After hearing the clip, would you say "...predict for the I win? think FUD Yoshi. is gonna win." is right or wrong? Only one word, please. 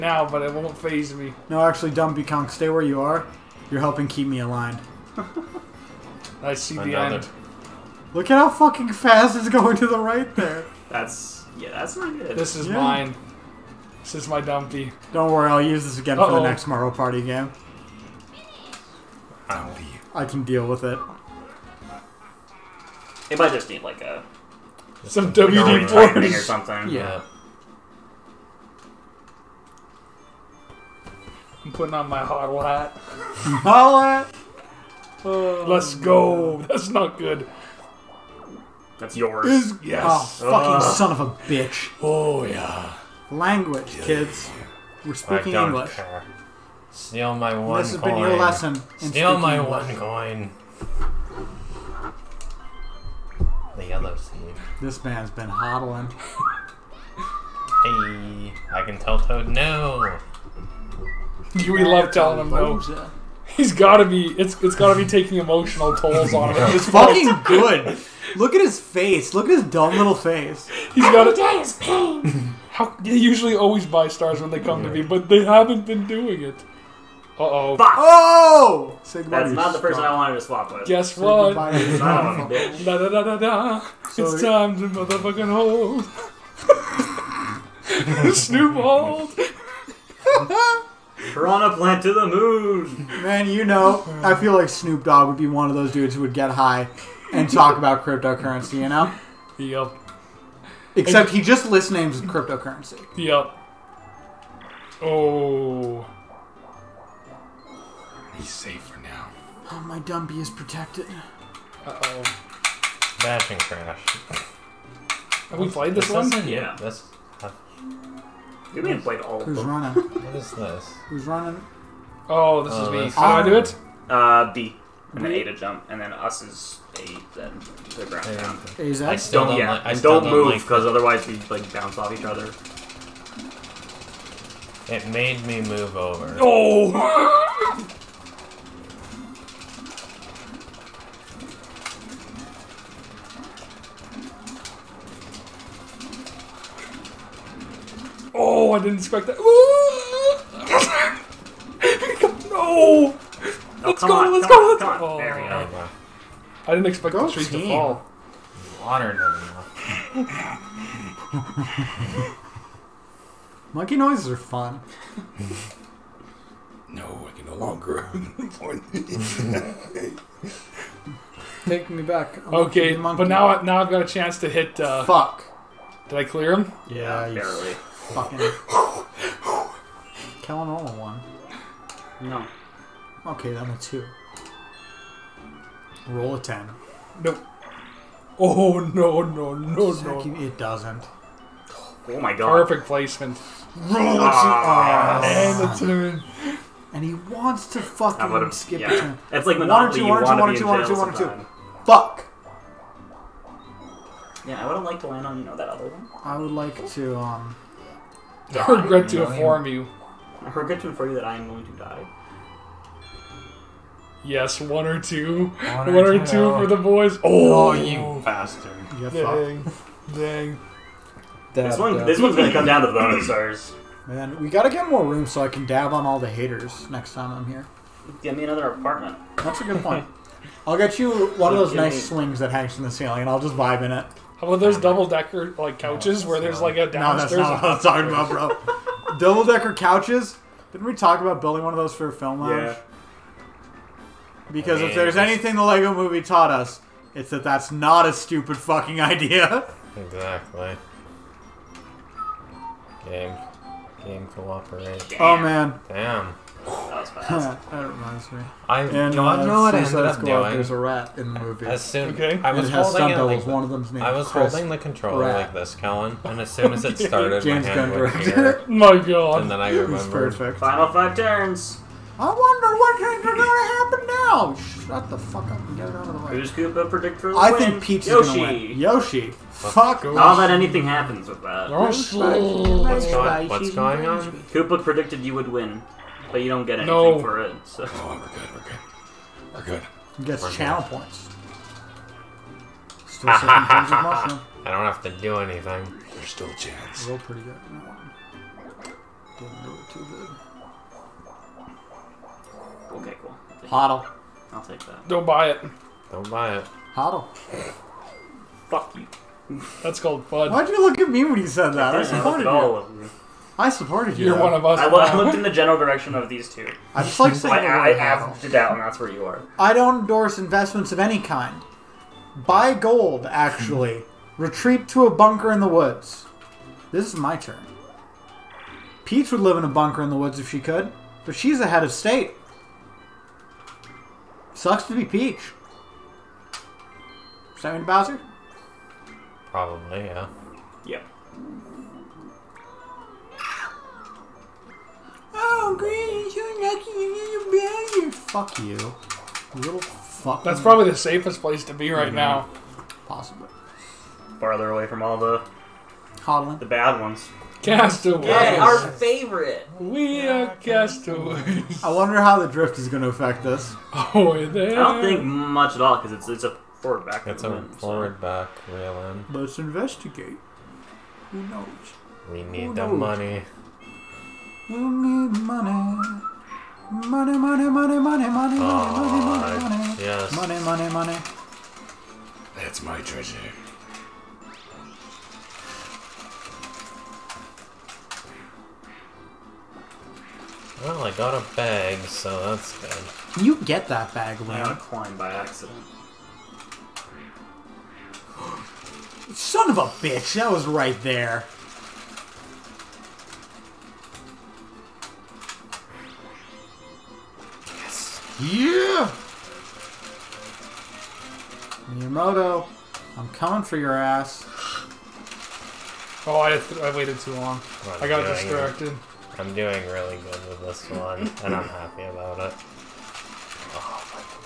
wrong.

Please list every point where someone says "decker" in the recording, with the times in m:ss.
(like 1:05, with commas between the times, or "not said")
3:55, 3:59.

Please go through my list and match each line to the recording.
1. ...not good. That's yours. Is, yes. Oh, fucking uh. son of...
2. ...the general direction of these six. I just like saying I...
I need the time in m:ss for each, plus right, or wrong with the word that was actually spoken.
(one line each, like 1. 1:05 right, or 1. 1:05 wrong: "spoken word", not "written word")
1. 0:36 right
2. 5:15 wrong: "two", not "six".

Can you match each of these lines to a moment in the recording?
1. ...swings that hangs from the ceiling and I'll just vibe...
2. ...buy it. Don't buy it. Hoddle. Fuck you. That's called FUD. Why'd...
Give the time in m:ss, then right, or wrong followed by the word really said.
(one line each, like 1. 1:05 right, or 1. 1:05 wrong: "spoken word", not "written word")
1. 3:52 right
2. 5:05 right.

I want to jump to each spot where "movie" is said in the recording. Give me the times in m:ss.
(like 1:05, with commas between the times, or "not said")
4:05, 4:21.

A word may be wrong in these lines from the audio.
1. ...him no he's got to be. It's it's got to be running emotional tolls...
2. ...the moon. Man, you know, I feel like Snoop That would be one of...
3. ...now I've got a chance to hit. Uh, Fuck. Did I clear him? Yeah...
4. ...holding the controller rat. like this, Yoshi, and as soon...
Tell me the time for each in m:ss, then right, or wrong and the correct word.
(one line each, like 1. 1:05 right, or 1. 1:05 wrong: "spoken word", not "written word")
1. 1:02 wrong: "taking", not "running"
2. 1:32 wrong: "Dogg", not "That"
3. 2:53 right
4. 4:24 wrong: "Colin", not "Yoshi".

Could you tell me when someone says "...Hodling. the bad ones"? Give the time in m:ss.
5:56.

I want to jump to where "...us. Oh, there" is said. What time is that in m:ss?
6:03.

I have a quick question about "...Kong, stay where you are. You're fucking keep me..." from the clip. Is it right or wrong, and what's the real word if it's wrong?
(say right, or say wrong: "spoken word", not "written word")
wrong: "helping", not "fucking".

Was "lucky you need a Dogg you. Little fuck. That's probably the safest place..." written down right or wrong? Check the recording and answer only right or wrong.
wrong.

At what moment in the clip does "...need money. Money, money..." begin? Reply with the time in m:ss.
6:14.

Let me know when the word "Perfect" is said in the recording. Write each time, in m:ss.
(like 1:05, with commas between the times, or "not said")
3:12, 4:30.